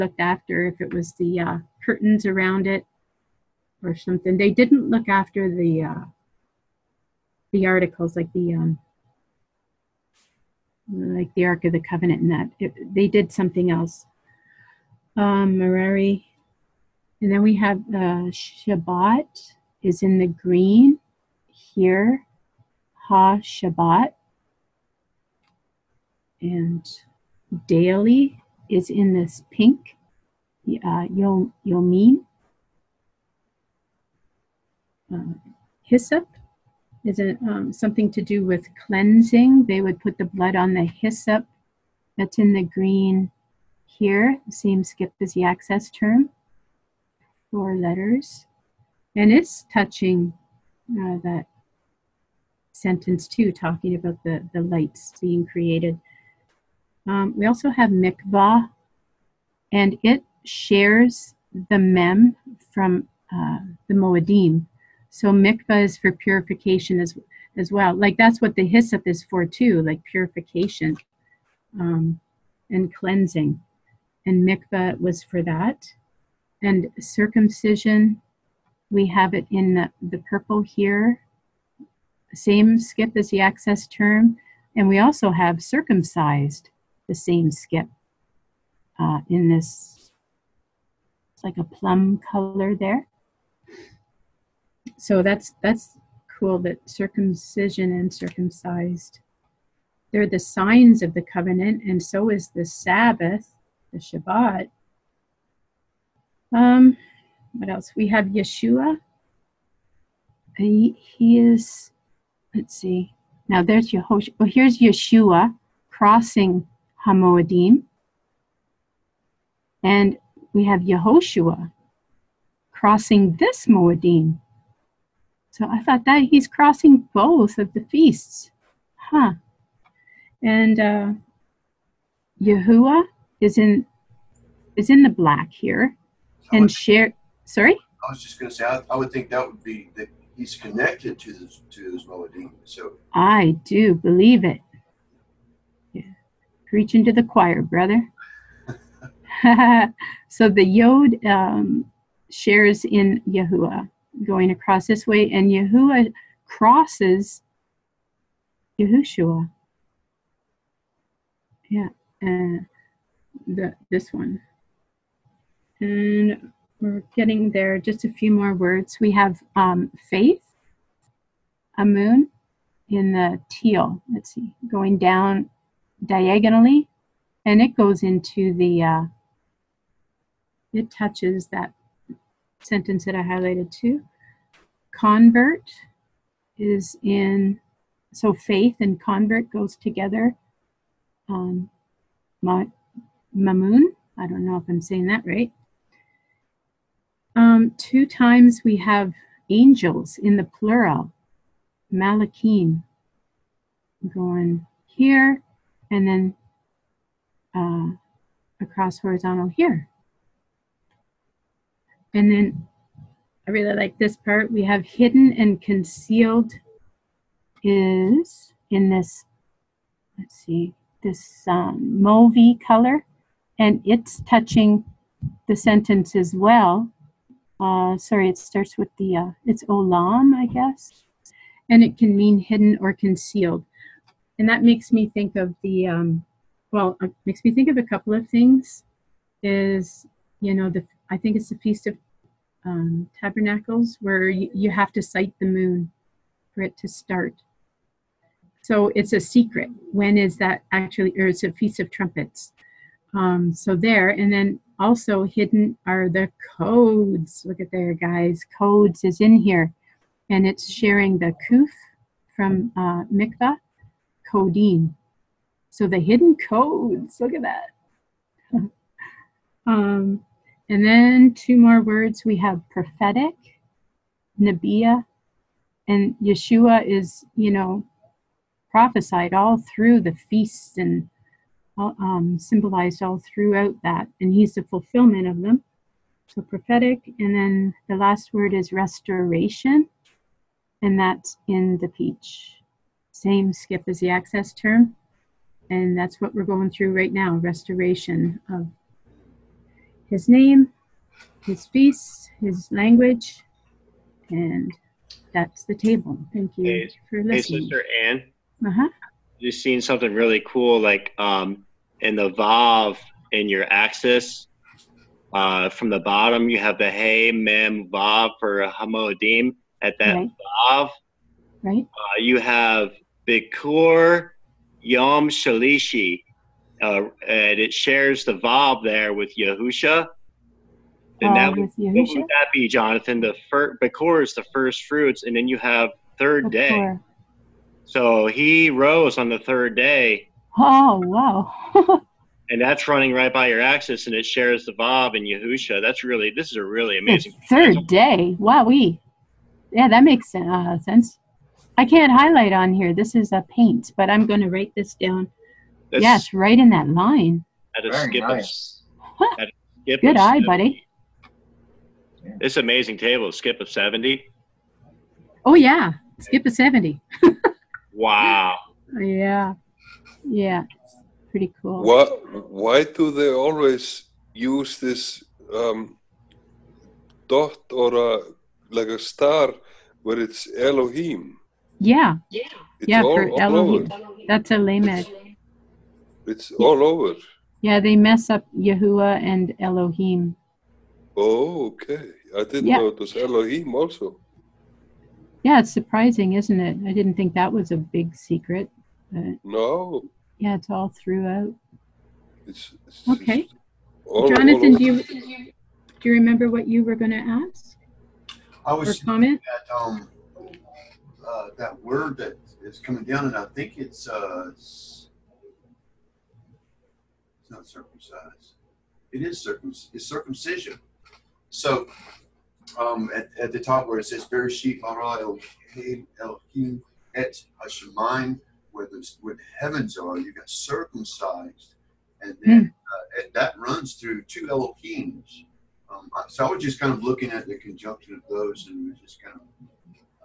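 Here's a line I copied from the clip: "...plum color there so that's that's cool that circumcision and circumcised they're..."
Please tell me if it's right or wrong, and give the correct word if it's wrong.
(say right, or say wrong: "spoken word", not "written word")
right.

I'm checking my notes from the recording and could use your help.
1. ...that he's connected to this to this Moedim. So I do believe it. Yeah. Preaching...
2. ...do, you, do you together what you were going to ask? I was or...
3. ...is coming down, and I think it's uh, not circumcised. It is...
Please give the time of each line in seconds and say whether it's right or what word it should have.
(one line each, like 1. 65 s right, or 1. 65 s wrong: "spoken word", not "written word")
1. 139 s right
2. 404 s wrong: "remember", not "together"
3. 412 s right.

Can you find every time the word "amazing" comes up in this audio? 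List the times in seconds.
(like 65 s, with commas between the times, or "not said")
346 s, 362 s.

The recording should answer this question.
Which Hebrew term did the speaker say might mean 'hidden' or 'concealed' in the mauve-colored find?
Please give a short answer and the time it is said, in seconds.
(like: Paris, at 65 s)
olam, at 229 s.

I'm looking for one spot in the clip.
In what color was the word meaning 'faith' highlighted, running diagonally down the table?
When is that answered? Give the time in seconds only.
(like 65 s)
172 s.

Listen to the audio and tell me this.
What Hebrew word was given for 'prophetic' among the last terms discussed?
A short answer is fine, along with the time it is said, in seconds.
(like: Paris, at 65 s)
Nabiya, at 274 s.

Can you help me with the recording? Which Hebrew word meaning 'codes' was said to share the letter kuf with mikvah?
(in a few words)
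codeine.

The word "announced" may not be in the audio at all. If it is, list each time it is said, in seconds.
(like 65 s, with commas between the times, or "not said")
not said.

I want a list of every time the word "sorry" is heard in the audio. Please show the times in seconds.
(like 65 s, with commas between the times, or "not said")
137 s, 227 s.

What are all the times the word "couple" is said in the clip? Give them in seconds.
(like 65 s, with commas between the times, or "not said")
237 s.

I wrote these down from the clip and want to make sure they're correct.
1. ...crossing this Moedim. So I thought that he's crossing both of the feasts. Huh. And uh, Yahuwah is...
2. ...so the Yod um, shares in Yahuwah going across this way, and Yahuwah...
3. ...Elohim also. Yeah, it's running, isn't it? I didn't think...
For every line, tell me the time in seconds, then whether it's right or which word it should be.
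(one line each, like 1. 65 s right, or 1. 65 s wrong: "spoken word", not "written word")
1. 122 s right
2. 150 s right
3. 393 s wrong: "surprising", not "running".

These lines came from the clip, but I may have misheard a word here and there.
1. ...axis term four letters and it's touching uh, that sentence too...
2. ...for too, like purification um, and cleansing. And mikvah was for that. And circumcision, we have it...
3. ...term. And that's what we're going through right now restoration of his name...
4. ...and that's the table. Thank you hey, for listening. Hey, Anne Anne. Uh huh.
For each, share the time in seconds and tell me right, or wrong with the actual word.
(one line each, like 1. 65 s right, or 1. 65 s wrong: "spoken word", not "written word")
1. 45 s right
2. 69 s right
3. 294 s right
4. 304 s wrong: "Sister", not "Anne".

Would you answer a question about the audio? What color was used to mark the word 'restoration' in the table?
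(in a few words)
peach.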